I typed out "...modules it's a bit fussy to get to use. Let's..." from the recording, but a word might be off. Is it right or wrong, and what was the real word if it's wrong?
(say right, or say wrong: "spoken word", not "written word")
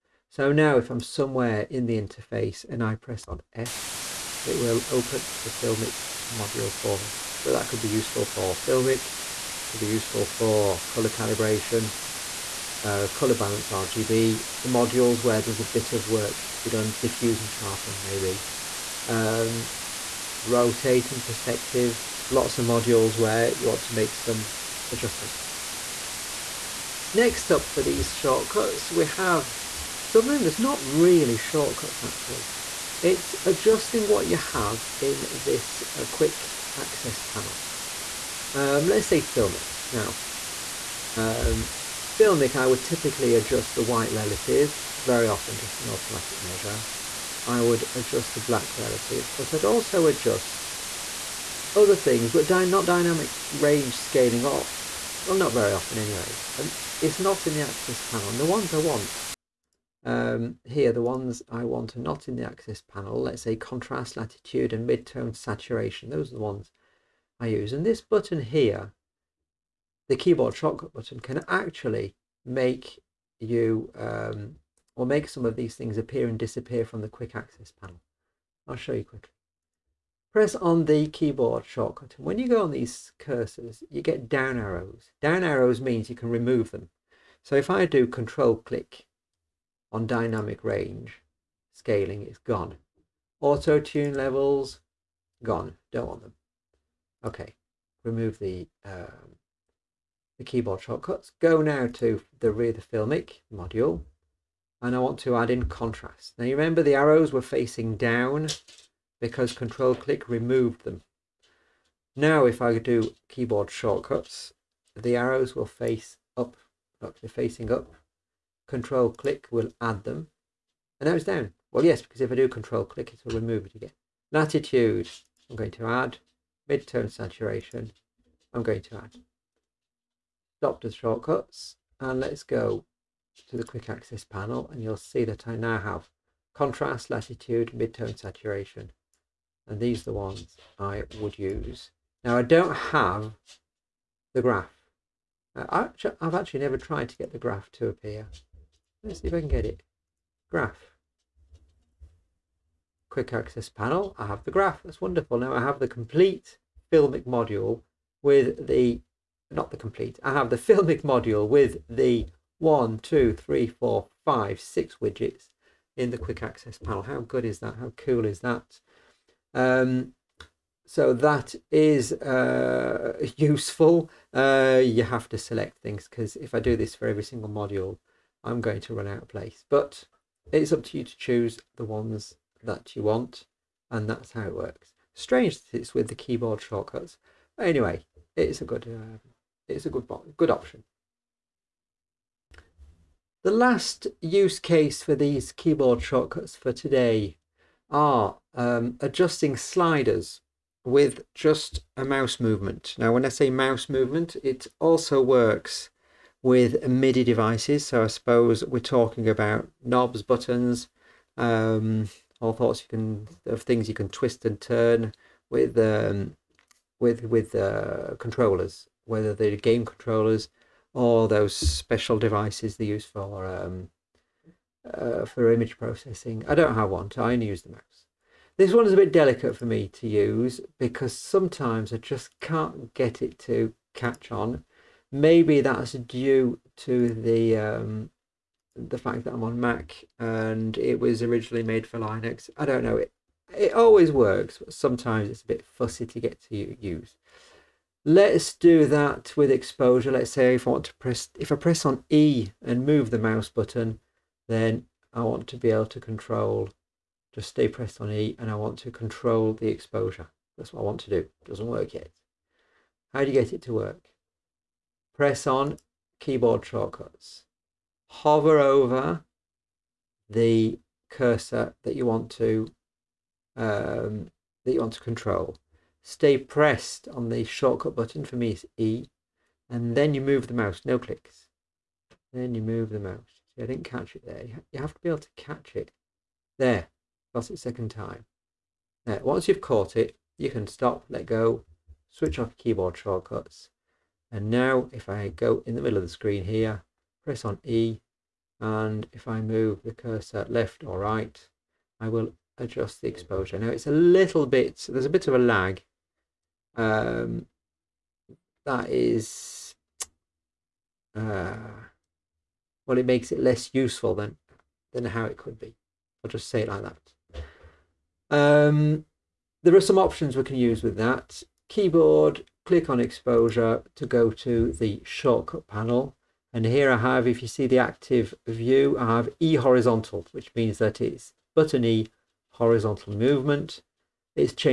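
wrong: "sometimes", not "modules".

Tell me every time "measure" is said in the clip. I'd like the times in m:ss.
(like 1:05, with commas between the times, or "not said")
0:46.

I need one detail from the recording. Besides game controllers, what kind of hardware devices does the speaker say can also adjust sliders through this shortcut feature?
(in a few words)
MIDI devices.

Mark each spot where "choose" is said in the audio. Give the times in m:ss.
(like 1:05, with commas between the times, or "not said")
3:01.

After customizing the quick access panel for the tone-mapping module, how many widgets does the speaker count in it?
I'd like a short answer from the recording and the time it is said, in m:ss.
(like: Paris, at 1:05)
6, at 2:44.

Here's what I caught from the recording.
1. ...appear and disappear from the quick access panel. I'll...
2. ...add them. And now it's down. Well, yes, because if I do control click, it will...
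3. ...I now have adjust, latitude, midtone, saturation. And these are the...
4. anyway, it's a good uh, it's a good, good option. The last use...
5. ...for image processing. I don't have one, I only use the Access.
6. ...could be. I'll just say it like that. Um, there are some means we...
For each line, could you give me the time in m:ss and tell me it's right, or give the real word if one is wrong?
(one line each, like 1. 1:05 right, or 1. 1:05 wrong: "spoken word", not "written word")
1. 1:15 right
2. 1:59 right
3. 2:15 wrong: "contrast", not "adjust"
4. 3:07 right
5. 3:45 wrong: "Macs", not "Access"
6. 5:15 wrong: "options", not "means".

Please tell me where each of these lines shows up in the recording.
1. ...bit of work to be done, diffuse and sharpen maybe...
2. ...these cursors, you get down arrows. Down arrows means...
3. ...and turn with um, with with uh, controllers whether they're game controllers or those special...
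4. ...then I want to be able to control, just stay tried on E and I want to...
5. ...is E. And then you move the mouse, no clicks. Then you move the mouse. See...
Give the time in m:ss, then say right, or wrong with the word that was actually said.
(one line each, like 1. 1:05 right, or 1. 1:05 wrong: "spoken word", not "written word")
1. 0:15 right
2. 1:22 right
3. 3:34 right
4. 4:14 wrong: "pressed", not "tried"
5. 4:38 right.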